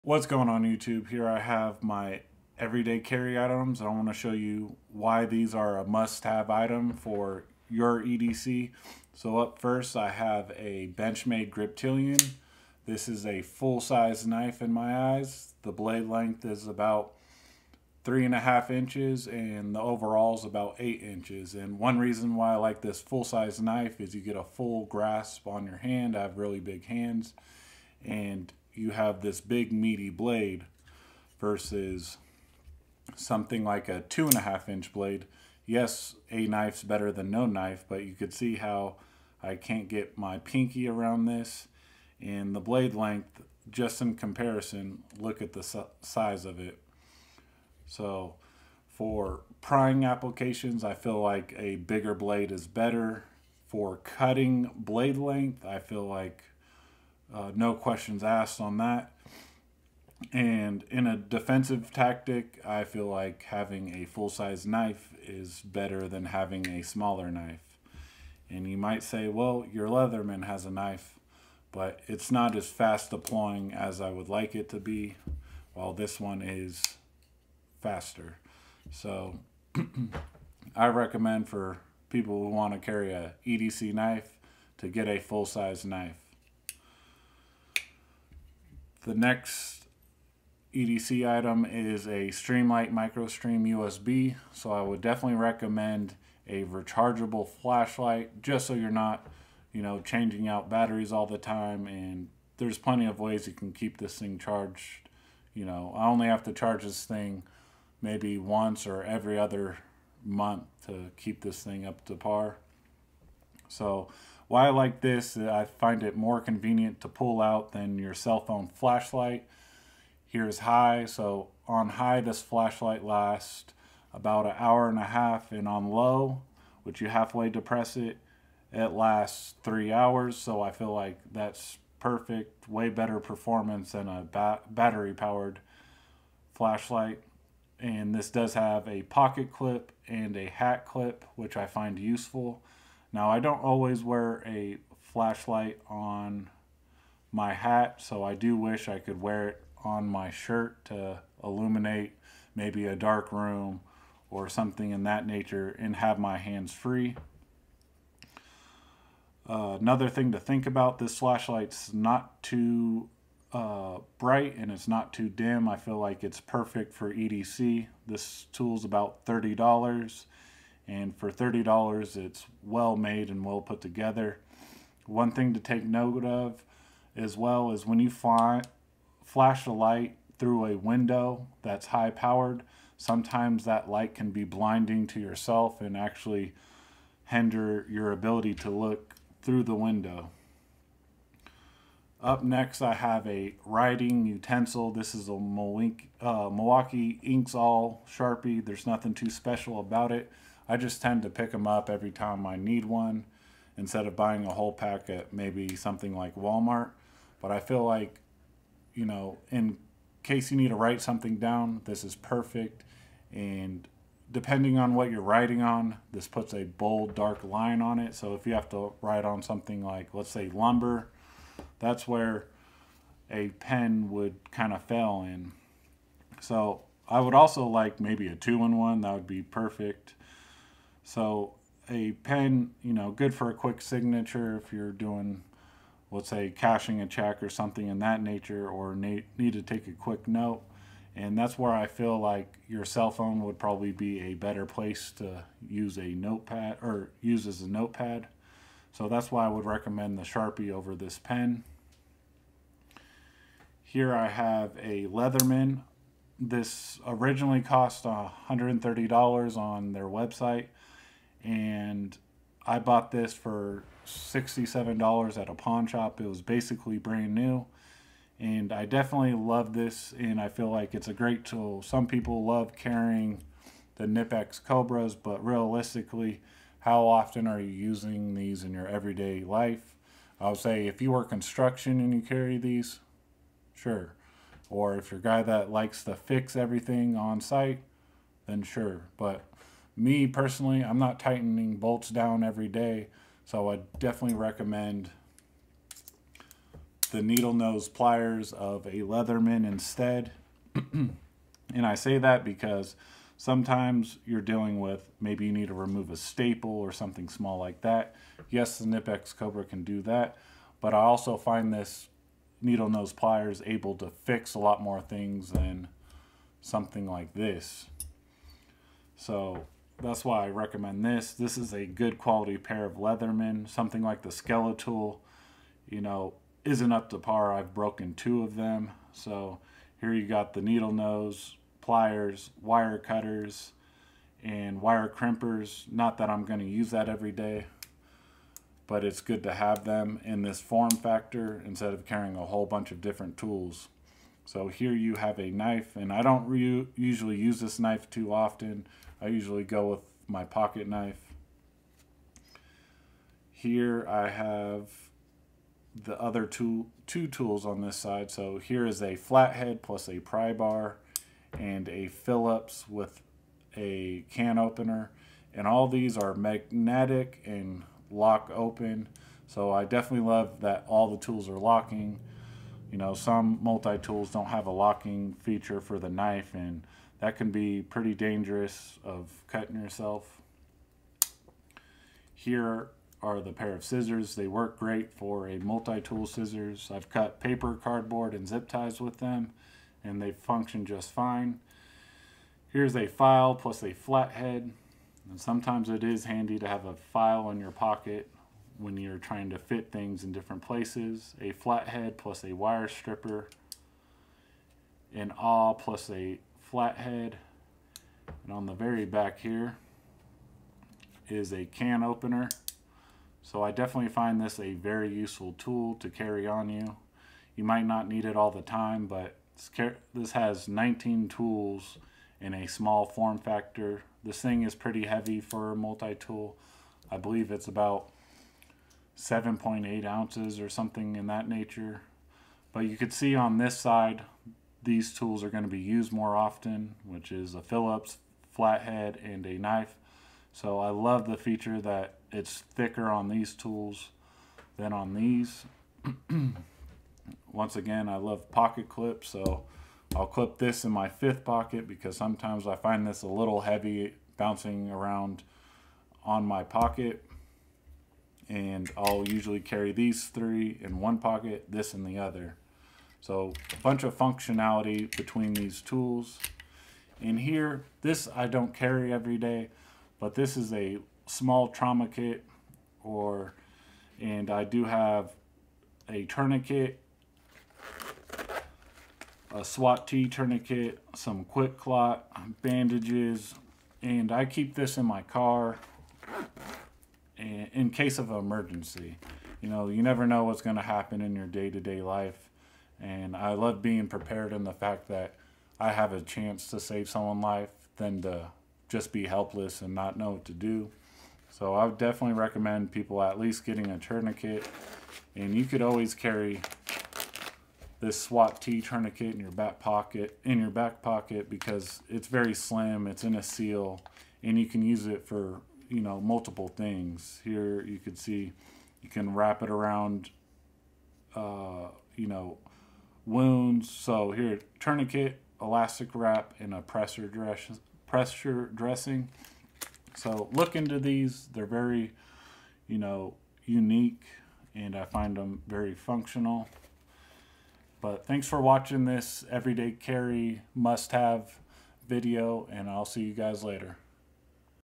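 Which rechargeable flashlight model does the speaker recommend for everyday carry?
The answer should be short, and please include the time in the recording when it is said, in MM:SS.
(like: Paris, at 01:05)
Streamlight MicroStream USB, at 01:32.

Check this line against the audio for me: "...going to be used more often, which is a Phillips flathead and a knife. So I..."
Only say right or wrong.
right.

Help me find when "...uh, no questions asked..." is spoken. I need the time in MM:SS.
00:57.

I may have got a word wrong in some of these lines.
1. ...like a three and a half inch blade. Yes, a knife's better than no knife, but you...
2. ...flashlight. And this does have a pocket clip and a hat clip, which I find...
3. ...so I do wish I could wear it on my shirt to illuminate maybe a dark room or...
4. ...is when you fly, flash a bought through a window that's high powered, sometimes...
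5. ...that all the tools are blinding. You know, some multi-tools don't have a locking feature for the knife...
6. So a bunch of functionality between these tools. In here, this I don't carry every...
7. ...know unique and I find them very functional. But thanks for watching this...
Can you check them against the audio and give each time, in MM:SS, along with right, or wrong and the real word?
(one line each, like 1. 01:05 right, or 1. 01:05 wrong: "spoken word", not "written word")
1. 00:33 wrong: "two", not "three"
2. 02:16 right
3. 02:28 right
4. 02:57 wrong: "light", not "bought"
5. 06:10 wrong: "locking", not "blinding"
6. 07:43 right
7. 08:52 right.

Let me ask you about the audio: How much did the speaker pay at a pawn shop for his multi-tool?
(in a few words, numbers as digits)
$67.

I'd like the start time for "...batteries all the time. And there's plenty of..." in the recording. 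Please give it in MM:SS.
01:40.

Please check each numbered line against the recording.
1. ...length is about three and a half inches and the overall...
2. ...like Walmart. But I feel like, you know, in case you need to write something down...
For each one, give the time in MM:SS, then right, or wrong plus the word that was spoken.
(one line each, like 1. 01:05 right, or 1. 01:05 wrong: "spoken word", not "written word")
1. 00:16 right
2. 03:26 right.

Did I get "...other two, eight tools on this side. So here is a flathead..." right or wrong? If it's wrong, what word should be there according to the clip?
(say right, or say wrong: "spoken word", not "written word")
wrong: "two", not "eight".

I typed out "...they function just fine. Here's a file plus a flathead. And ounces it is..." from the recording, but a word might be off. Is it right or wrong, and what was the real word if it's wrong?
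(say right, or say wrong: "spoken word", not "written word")
wrong: "sometimes", not "ounces".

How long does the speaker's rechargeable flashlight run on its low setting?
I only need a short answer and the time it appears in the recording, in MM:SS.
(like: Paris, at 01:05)
3 hours, at 02:09.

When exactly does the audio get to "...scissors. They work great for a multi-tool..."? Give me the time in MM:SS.
06:23.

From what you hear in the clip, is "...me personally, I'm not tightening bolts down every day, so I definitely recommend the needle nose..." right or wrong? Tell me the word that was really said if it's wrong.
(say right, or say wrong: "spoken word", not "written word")
right.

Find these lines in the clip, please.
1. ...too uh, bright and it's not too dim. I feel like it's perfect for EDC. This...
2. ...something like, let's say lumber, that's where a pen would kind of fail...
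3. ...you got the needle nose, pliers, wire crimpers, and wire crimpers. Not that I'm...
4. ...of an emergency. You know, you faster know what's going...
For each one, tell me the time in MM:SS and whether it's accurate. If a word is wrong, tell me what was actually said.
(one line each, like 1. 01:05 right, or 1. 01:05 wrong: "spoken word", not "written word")
1. 02:42 right
2. 03:39 right
3. 05:30 wrong: "cutters", not "crimpers"
4. 08:08 wrong: "never", not "faster".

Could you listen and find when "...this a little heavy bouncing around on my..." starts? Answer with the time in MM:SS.
07:33.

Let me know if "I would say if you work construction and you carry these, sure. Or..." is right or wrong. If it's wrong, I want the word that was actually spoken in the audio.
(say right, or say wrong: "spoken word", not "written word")
right.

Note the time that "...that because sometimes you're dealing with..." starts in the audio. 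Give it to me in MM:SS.
05:02.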